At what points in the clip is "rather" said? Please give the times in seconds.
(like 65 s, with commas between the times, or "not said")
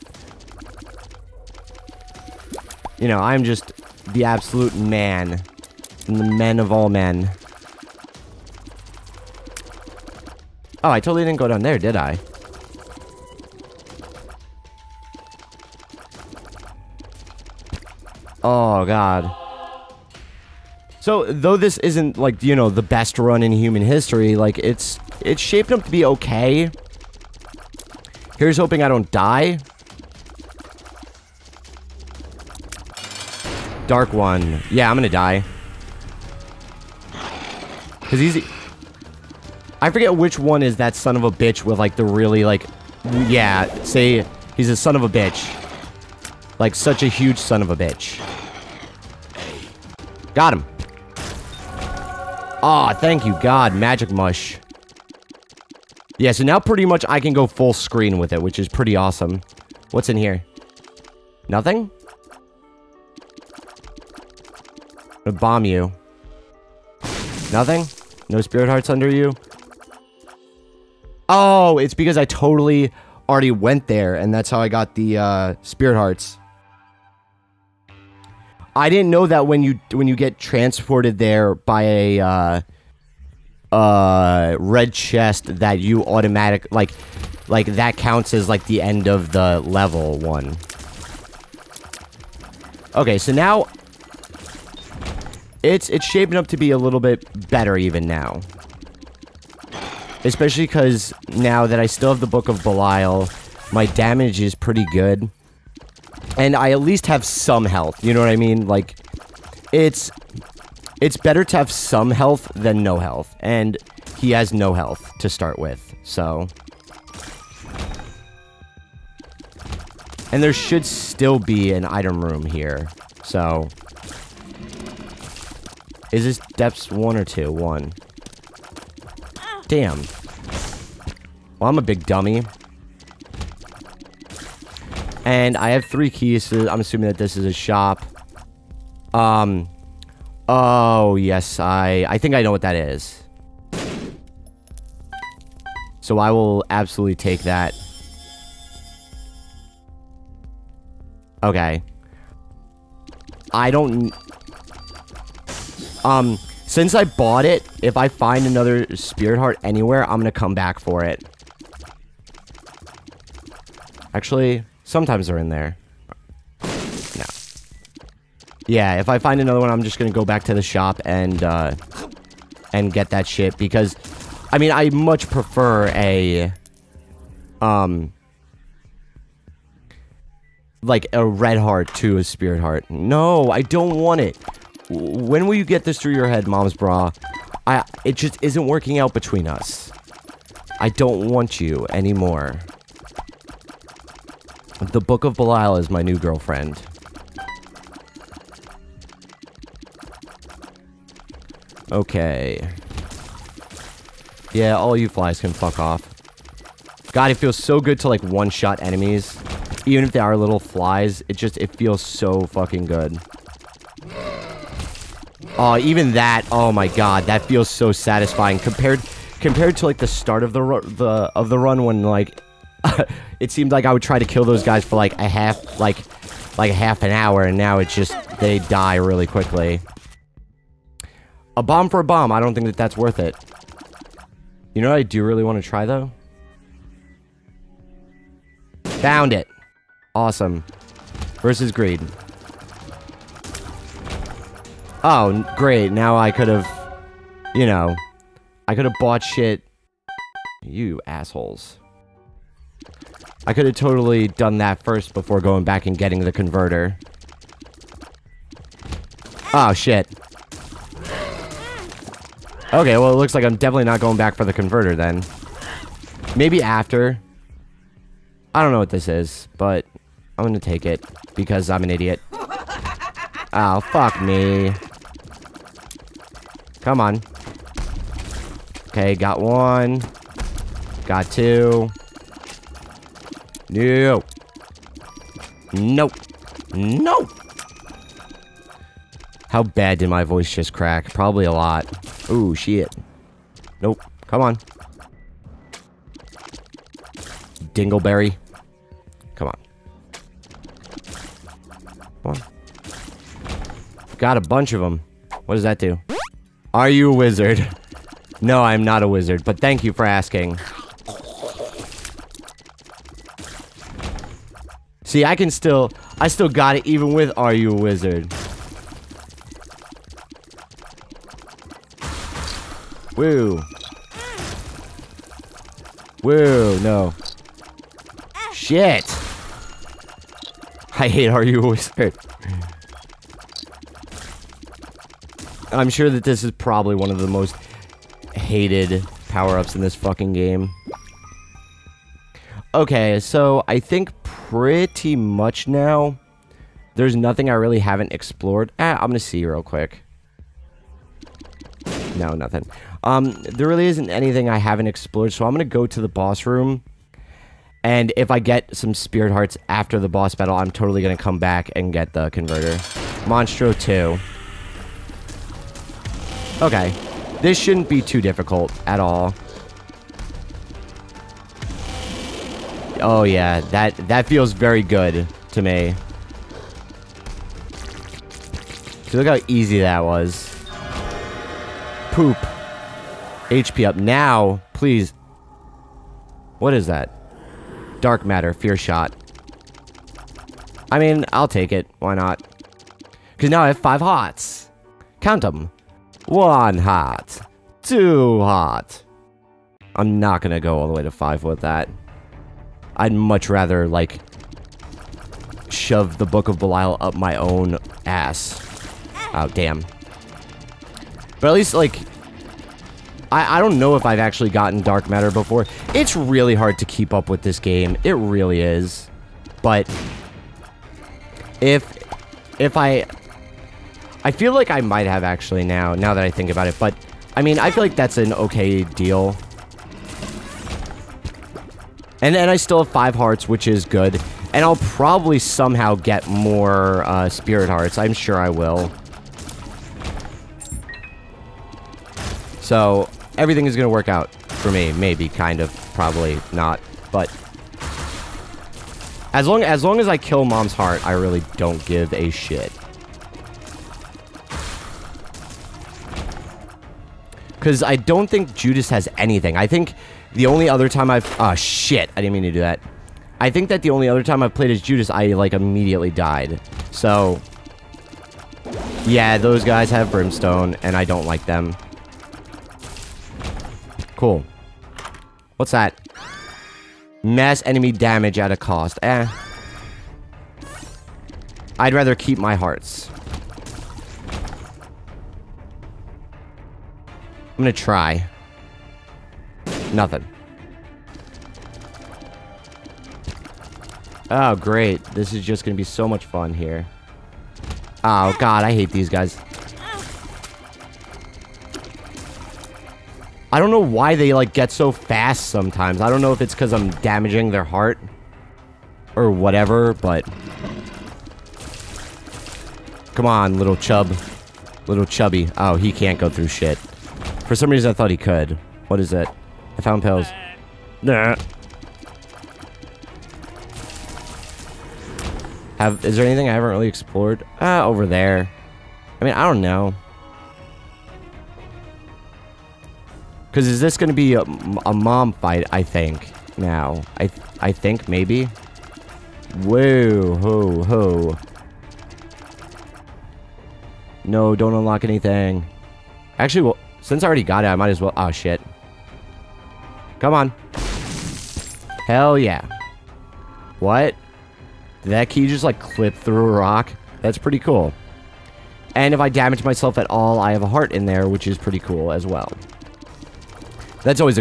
403 s, 481 s.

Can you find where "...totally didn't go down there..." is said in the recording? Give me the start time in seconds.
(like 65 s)
10 s.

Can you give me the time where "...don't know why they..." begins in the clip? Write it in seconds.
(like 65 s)
503 s.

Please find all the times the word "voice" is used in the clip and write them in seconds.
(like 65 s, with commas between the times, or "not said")
290 s.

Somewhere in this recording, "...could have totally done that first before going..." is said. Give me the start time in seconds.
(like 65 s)
253 s.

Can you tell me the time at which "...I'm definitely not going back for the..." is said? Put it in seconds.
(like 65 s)
263 s.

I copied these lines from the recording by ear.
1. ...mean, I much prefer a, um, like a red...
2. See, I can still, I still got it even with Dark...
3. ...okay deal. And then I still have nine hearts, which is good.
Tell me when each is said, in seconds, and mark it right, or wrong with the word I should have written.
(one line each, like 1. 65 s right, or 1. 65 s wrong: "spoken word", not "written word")
1. 174 s right
2. 315 s wrong: "Are", not "Dark"
3. 428 s wrong: "five", not "nine".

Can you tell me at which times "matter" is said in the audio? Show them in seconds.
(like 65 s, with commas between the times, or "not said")
388 s, 415 s.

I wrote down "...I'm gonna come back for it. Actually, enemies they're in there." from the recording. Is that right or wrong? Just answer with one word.
wrong.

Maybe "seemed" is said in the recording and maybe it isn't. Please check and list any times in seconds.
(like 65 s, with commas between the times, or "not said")
223 s.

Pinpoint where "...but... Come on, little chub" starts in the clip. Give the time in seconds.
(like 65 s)
509 s.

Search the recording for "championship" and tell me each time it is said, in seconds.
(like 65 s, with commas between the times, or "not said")
not said.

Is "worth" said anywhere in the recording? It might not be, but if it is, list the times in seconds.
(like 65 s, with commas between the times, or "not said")
232 s.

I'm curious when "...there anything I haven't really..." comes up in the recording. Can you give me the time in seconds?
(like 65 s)
526 s.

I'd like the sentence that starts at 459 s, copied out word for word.
I think the only other time I've...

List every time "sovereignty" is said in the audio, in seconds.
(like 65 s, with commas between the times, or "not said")
not said.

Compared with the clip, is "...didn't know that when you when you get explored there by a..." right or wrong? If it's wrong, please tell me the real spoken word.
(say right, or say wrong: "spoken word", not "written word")
wrong: "transported", not "explored".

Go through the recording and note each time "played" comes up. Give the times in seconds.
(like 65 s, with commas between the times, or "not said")
464 s.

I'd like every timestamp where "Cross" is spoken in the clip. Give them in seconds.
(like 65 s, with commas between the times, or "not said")
not said.